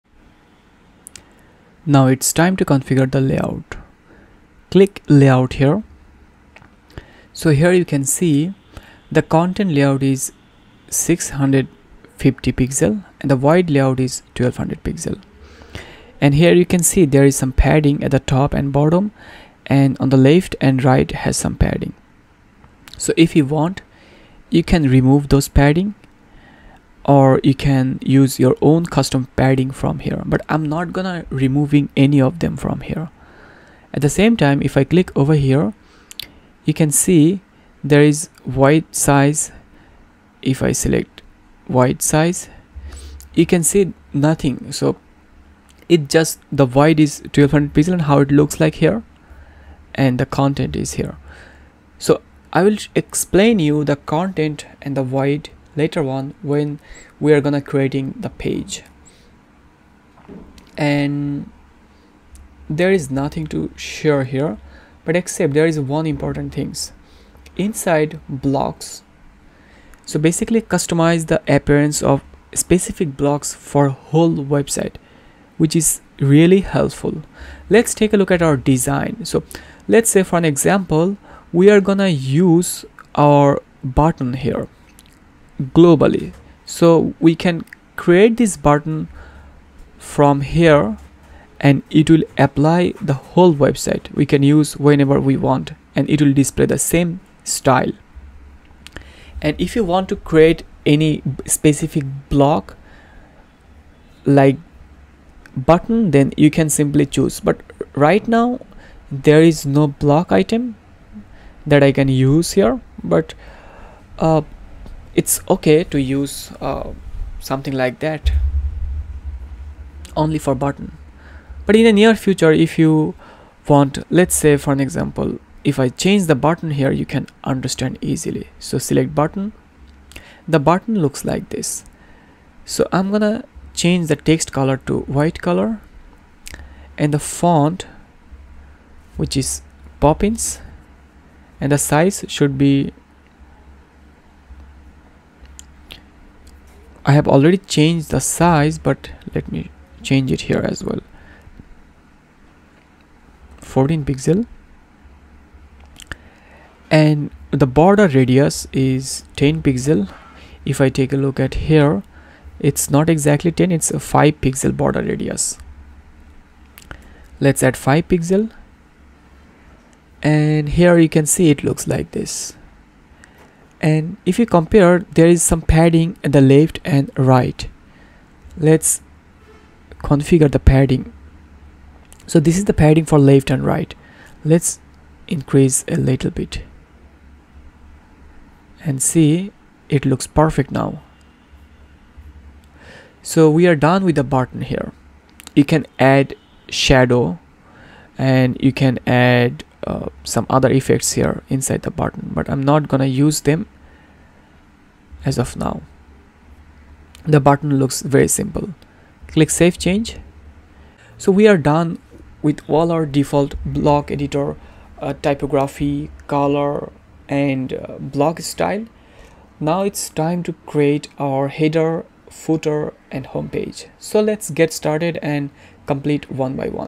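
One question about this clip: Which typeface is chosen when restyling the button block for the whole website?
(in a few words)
Poppins.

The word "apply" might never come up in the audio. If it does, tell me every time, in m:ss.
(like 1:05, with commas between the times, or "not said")
1:32.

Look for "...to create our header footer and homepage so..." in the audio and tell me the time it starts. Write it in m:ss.
3:40.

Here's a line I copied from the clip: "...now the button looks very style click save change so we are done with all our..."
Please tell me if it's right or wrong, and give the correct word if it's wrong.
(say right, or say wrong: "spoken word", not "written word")
wrong: "simple", not "style".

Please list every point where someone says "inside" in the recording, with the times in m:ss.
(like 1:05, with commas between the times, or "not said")
1:07, 3:21.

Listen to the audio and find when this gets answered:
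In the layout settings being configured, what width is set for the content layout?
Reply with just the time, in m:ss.
0:10.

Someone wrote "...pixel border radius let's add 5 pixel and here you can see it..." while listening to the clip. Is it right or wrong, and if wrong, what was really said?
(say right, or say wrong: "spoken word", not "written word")
right.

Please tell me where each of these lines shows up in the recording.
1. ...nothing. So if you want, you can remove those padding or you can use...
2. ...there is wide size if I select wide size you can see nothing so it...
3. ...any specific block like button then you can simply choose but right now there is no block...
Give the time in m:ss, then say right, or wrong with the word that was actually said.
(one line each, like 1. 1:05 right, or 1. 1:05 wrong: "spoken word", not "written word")
1. 0:21 wrong: "padding", not "nothing"
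2. 0:37 right
3. 1:40 right.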